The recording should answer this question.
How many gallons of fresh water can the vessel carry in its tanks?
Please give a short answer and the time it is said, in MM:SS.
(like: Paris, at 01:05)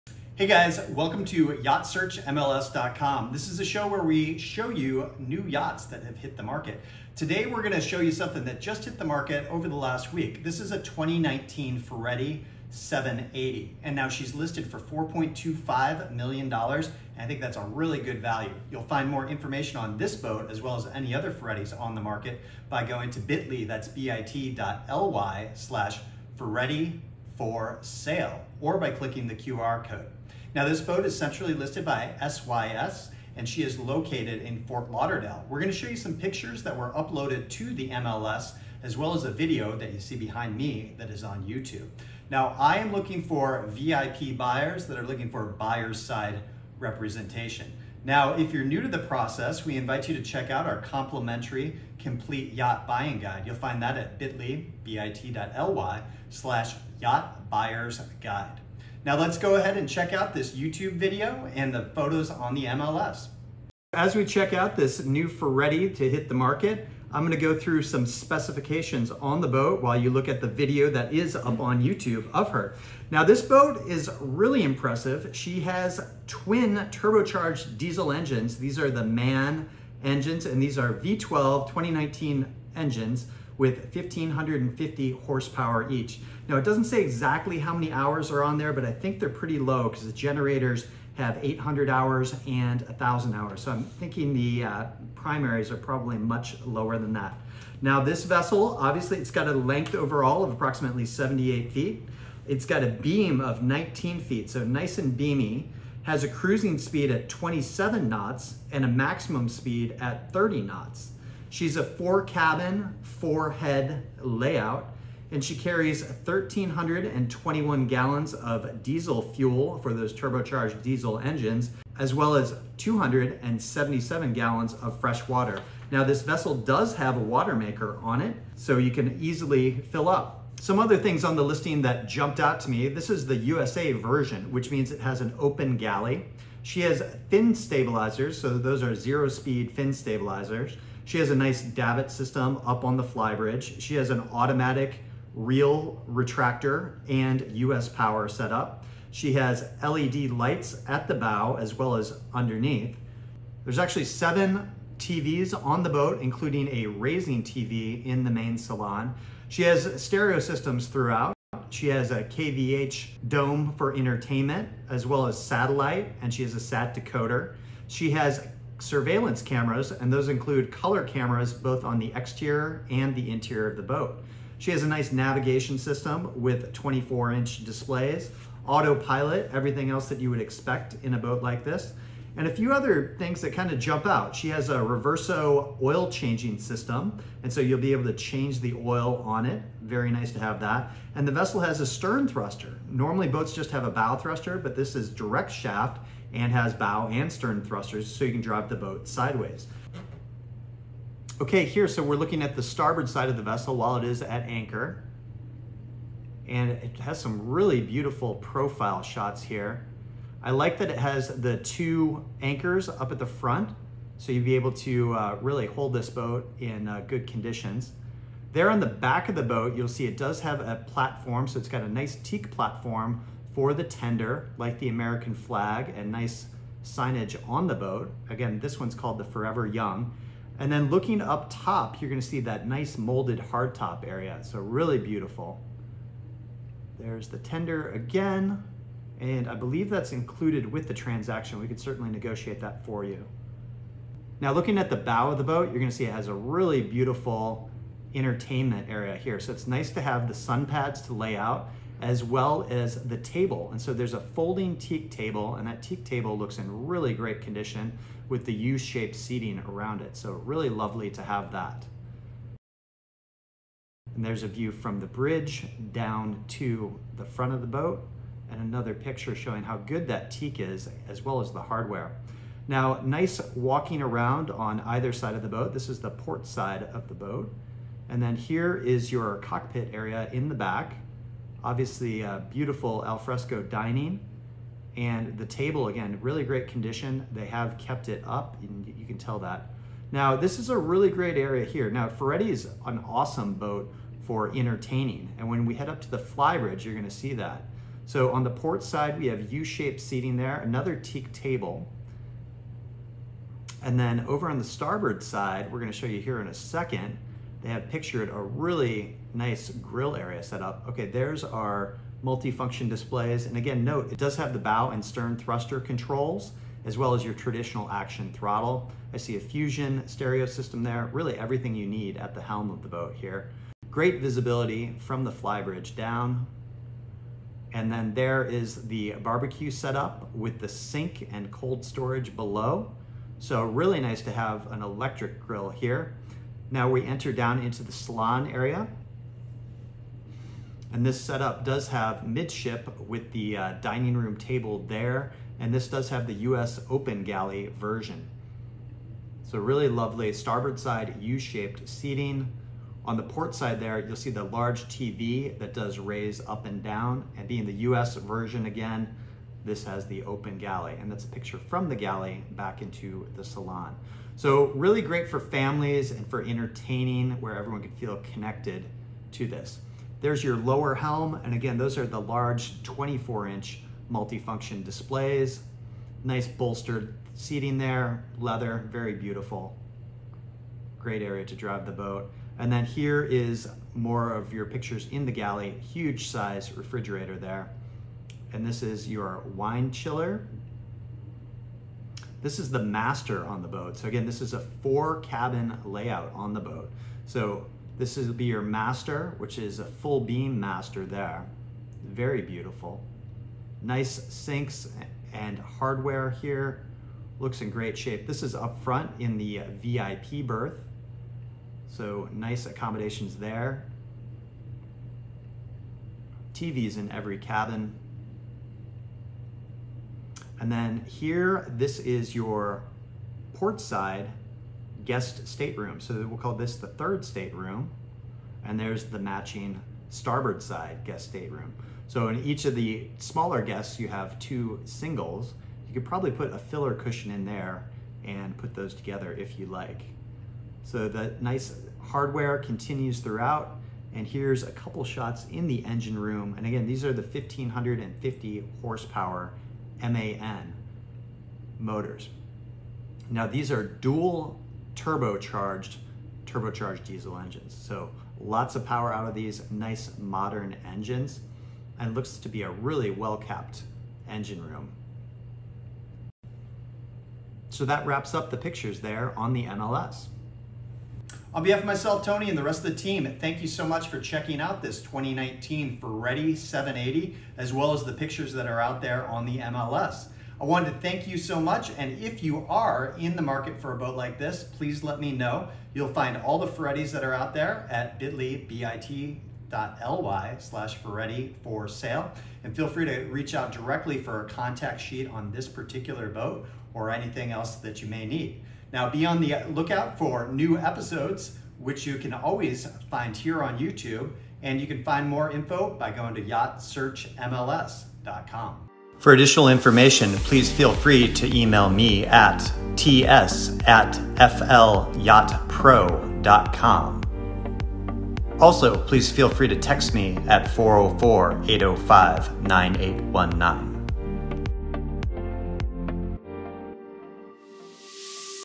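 277, at 02:02.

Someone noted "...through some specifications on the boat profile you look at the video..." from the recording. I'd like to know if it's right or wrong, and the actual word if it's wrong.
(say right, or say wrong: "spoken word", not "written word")
wrong: "while", not "profile".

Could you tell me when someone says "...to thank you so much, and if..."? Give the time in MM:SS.
08:00.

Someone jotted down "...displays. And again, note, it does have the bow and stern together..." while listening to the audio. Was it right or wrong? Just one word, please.
wrong.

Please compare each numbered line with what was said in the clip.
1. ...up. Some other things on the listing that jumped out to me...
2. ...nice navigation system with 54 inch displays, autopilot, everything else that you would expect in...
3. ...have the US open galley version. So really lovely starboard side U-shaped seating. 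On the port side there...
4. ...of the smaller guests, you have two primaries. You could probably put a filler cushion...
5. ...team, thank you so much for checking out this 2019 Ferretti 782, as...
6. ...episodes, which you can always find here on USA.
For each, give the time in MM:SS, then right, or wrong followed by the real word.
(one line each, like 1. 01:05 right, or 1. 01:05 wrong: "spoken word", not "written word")
1. 02:10 right
2. 02:54 wrong: "24", not "54"
3. 05:46 right
4. 07:12 wrong: "singles", not "primaries"
5. 07:52 wrong: "780", not "782"
6. 08:20 wrong: "YouTube", not "USA".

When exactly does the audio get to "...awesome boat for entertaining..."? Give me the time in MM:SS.
04:53.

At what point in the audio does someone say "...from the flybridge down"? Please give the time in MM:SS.
05:24.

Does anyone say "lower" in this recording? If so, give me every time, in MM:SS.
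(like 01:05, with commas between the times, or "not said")
01:36, 06:10.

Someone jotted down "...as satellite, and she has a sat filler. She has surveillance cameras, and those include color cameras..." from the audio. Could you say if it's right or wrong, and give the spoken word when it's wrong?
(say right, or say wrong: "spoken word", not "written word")
wrong: "decoder", not "filler".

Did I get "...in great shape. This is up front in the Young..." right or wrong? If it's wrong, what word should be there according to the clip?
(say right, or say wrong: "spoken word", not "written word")
wrong: "VIP", not "Young".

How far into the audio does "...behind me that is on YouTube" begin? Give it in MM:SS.
00:40.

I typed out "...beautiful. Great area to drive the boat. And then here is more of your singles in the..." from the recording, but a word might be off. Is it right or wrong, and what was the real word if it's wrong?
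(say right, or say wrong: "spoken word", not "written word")
wrong: "pictures", not "singles".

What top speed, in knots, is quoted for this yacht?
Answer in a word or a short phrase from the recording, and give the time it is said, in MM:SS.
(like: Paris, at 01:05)
30 knots, at 01:50.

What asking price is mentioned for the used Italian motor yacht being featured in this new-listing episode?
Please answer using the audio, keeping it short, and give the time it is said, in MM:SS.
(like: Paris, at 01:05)
$4.25 million, at 00:14.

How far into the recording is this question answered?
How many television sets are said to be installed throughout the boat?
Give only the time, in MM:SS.
02:34.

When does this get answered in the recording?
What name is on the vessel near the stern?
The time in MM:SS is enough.
03:49.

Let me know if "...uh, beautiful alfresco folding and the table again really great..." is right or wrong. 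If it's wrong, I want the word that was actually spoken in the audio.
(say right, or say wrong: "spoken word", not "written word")
wrong: "dining", not "folding".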